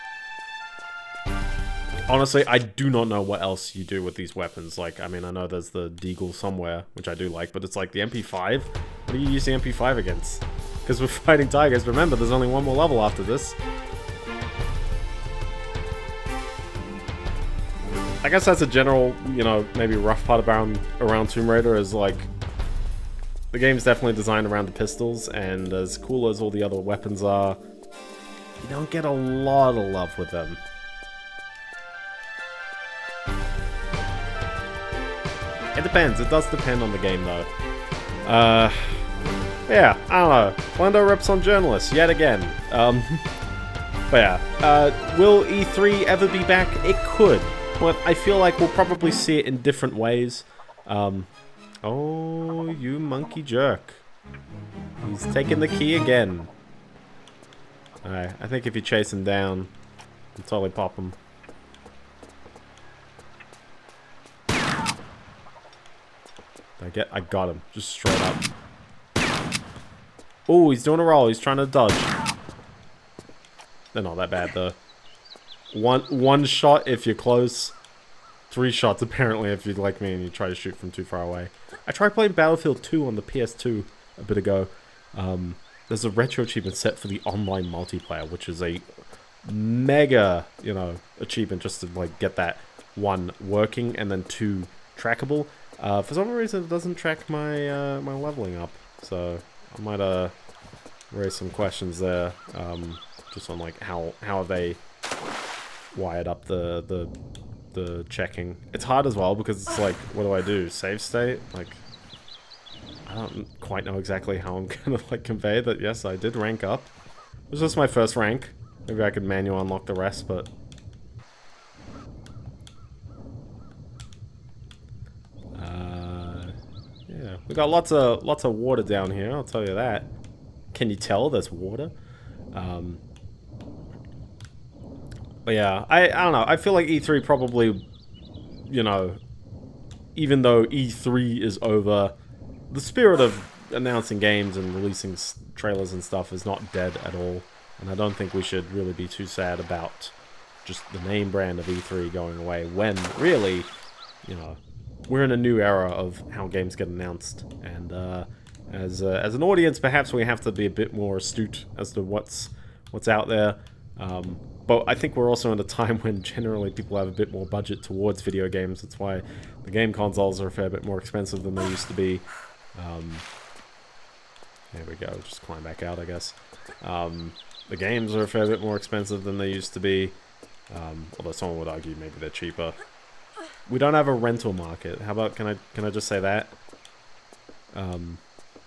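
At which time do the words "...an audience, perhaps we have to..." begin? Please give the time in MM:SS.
02:39.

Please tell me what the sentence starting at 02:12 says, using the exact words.
Um, but yeah, I, I don't know.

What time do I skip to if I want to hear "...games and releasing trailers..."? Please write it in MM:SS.
02:24.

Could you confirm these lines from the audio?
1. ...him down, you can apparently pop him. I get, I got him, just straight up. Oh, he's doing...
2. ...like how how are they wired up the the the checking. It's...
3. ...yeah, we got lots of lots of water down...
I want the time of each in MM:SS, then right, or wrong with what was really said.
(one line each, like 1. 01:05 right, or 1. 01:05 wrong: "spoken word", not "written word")
1. 00:59 wrong: "totally", not "apparently"
2. 01:43 right
3. 02:07 right.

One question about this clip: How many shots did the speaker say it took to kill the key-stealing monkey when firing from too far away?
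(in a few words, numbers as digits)
3.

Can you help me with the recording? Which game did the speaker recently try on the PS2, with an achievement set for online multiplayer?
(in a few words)
Battlefield 2.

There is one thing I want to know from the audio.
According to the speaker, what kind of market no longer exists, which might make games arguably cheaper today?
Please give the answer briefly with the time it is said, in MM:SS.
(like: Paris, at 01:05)
Rental market, at 03:04.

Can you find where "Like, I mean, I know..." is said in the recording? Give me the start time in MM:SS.
00:04.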